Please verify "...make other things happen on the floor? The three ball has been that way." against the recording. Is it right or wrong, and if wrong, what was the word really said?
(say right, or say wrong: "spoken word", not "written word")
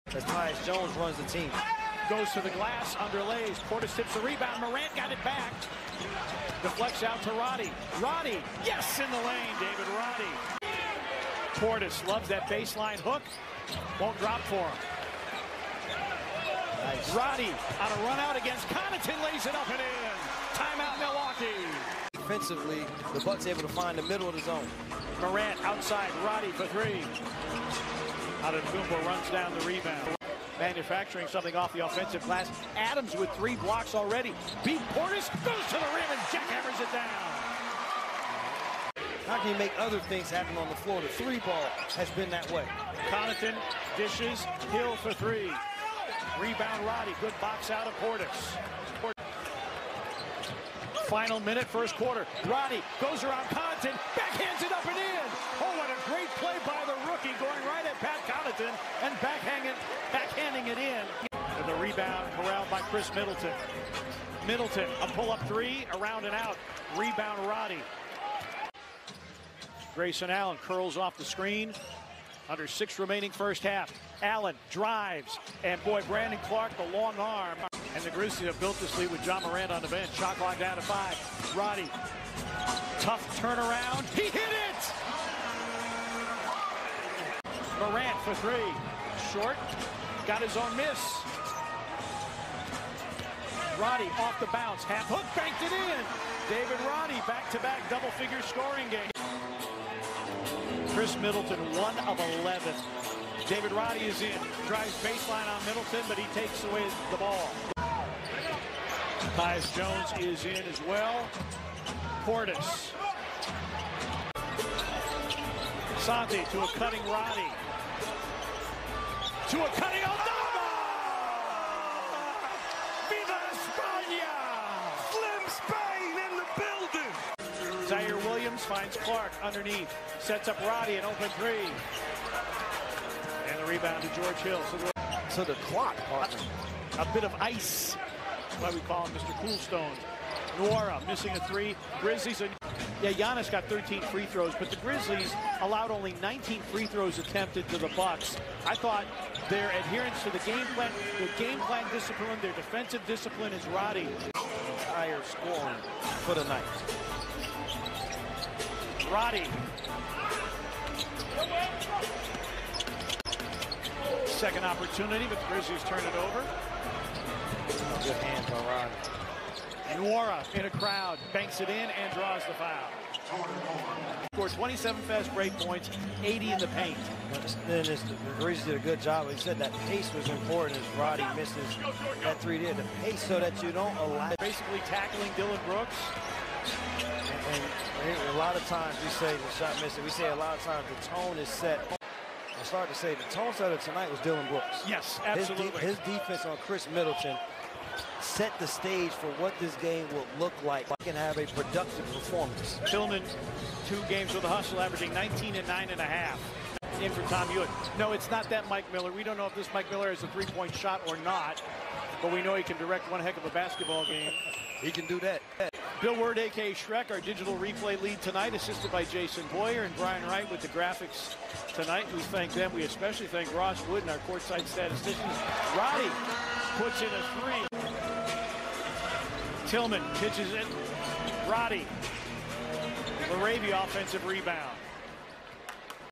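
right.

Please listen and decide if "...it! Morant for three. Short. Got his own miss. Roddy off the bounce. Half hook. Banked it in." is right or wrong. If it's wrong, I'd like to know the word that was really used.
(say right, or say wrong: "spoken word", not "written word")
right.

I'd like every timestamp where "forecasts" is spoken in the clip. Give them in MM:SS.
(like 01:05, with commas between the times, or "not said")
not said.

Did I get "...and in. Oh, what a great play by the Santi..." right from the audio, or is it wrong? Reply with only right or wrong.
wrong.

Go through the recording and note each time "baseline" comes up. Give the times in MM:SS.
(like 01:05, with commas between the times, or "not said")
00:12, 01:45.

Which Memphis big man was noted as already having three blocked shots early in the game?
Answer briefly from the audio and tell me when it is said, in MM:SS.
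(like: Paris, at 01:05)
Adams, at 00:32.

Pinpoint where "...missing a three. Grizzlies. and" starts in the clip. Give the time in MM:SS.
02:21.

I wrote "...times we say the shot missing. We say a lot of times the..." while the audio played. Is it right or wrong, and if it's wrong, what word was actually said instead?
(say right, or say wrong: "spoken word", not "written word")
right.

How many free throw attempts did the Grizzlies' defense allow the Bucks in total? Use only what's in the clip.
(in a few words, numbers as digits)
19.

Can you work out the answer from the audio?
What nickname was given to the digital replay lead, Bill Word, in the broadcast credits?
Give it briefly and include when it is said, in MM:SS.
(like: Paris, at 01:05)
Shrek, at 03:36.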